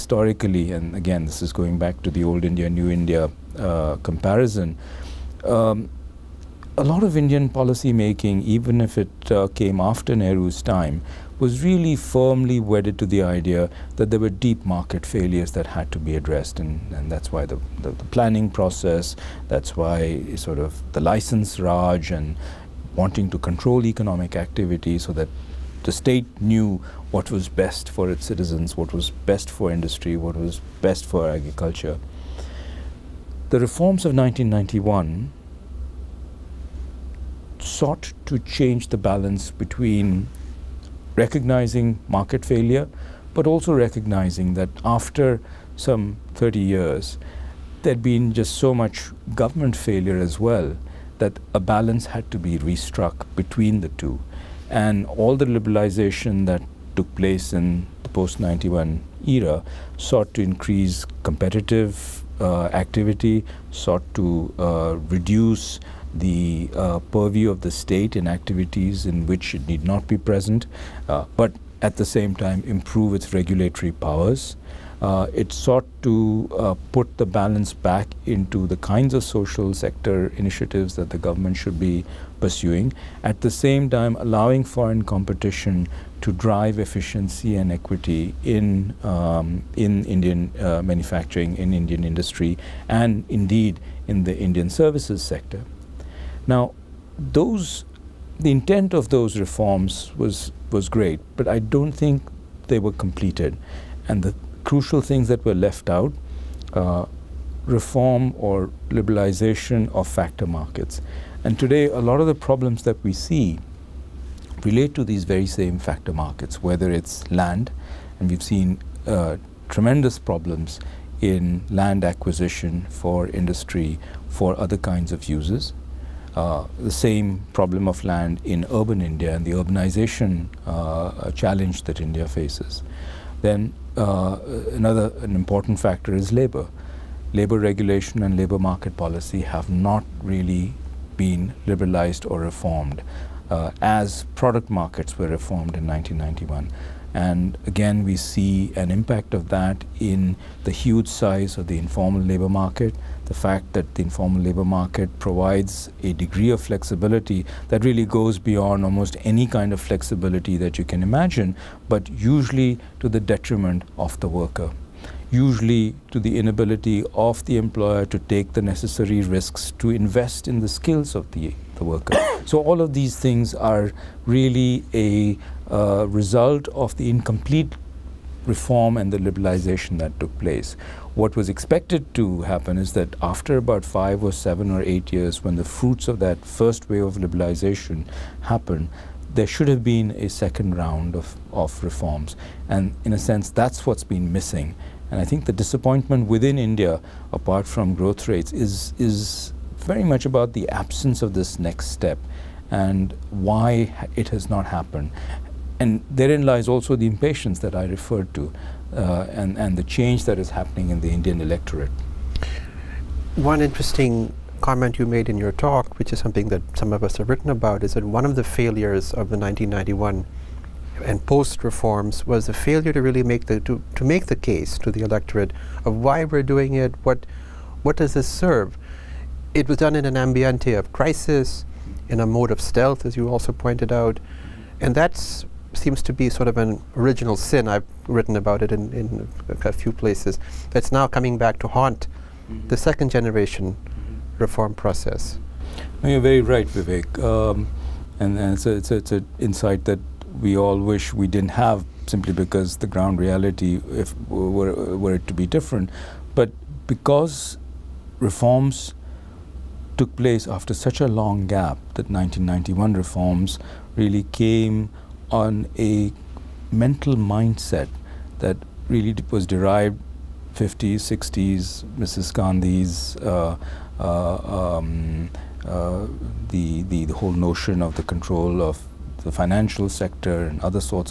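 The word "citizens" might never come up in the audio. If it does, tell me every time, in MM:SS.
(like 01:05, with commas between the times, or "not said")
00:28.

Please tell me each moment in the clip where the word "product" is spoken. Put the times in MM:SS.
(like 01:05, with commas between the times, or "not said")
02:24.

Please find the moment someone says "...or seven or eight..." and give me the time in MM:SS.
03:04.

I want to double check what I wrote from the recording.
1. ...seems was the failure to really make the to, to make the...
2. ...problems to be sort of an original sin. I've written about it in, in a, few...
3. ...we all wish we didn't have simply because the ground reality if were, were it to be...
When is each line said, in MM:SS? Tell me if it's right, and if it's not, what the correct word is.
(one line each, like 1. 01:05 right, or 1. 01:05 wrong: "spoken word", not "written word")
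1. 03:41 wrong: "reforms", not "seems"
2. 03:55 wrong: "seems", not "problems"
3. 04:10 right.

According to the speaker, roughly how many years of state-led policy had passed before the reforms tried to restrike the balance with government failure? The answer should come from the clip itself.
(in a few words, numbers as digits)
30.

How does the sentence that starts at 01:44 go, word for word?
And the crucial things that were left out, uh, reform or liberalization of factor markets.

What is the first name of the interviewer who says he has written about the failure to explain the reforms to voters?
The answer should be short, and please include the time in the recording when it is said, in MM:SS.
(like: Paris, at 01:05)
Vivek, at 04:06.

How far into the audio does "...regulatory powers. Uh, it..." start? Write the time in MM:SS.
01:13.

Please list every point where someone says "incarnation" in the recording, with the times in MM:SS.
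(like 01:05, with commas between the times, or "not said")
not said.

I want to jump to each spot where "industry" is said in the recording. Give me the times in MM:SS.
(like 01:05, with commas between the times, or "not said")
00:29, 01:32, 02:03.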